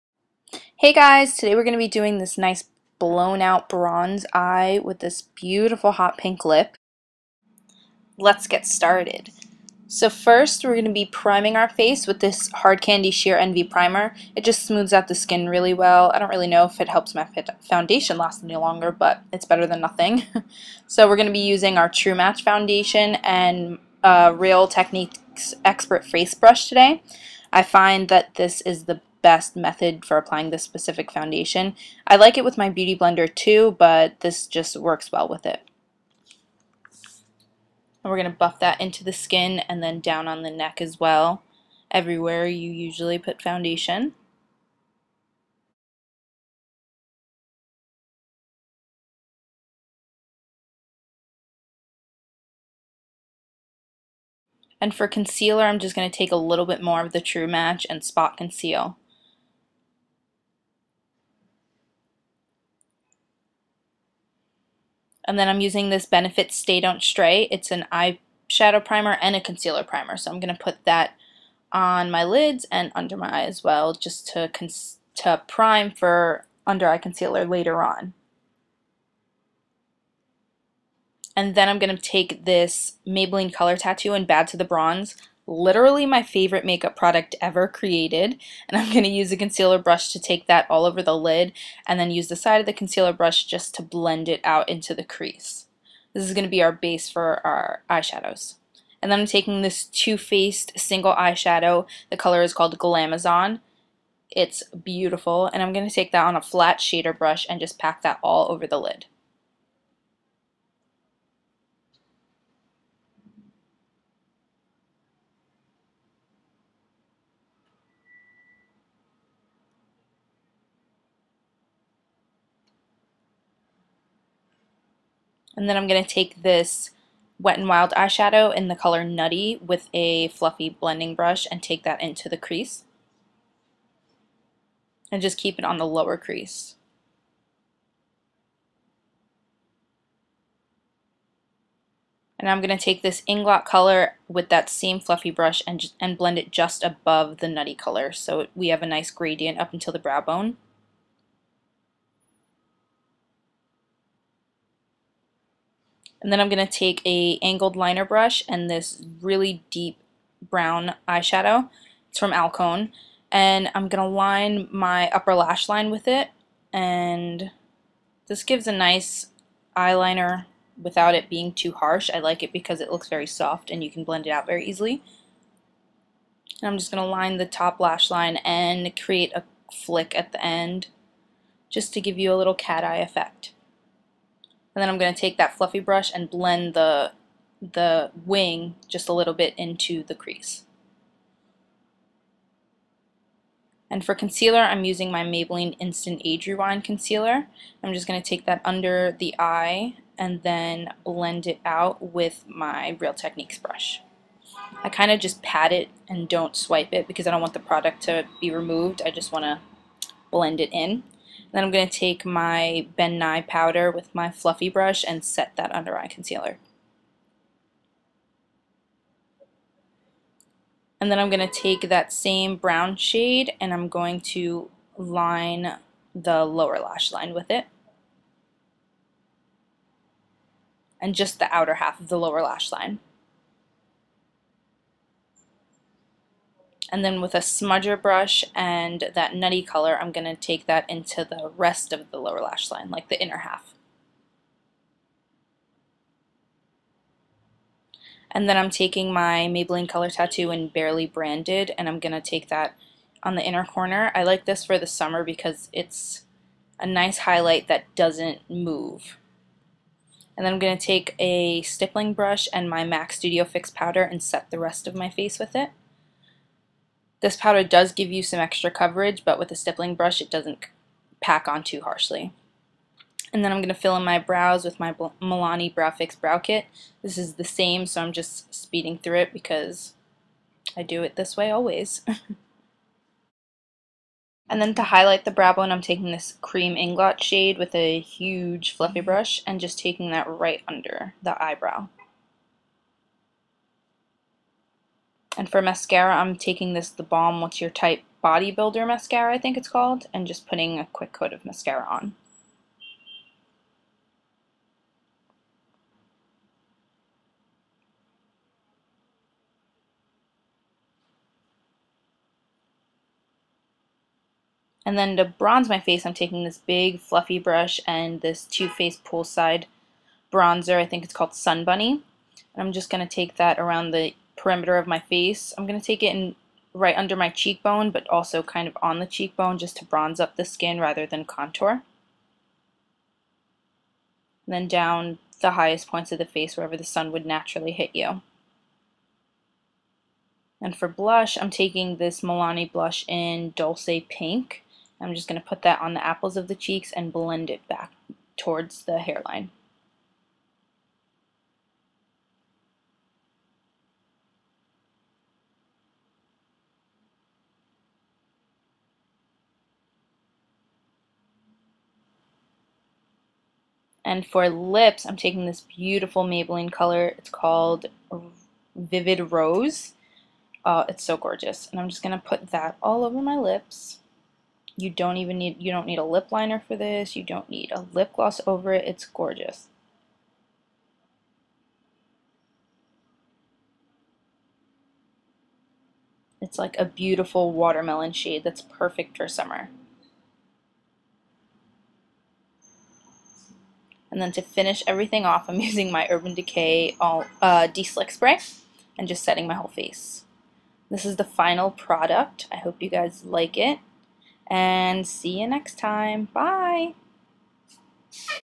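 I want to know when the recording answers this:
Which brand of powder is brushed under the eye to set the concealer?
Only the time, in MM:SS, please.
03:32.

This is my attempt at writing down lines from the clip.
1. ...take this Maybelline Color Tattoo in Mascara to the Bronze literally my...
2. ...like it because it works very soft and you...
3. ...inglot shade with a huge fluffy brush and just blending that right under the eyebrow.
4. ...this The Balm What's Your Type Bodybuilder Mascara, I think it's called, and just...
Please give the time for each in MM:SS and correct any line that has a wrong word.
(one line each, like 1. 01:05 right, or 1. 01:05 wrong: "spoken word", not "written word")
1. 01:22 wrong: "Bad", not "Mascara"
2. 02:52 wrong: "looks", not "works"
3. 04:46 wrong: "taking", not "blending"
4. 04:56 right.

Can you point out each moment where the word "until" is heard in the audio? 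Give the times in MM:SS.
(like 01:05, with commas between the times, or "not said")
02:29.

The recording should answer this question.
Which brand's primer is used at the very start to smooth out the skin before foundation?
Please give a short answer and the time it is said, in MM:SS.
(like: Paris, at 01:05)
Hard Candy, at 00:12.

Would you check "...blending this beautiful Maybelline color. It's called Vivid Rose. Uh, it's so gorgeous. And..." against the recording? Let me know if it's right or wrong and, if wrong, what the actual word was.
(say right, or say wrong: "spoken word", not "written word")
wrong: "taking", not "blending".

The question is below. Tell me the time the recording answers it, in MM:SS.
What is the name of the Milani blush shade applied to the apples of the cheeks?
05:43.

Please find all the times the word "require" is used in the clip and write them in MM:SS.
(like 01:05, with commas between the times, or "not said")
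not said.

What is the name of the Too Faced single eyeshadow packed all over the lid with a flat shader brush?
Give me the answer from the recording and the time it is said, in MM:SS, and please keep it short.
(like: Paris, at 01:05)
Glamazon, at 01:42.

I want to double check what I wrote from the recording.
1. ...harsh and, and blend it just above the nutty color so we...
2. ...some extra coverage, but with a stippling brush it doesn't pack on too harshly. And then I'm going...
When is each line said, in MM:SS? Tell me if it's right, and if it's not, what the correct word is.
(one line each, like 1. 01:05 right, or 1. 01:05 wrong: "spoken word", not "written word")
1. 02:25 wrong: "brush", not "harsh"
2. 04:28 right.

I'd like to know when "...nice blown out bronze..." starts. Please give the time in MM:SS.
00:02.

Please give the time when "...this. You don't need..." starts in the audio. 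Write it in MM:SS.
06:16.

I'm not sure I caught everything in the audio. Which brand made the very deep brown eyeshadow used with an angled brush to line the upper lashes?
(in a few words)
Alcone.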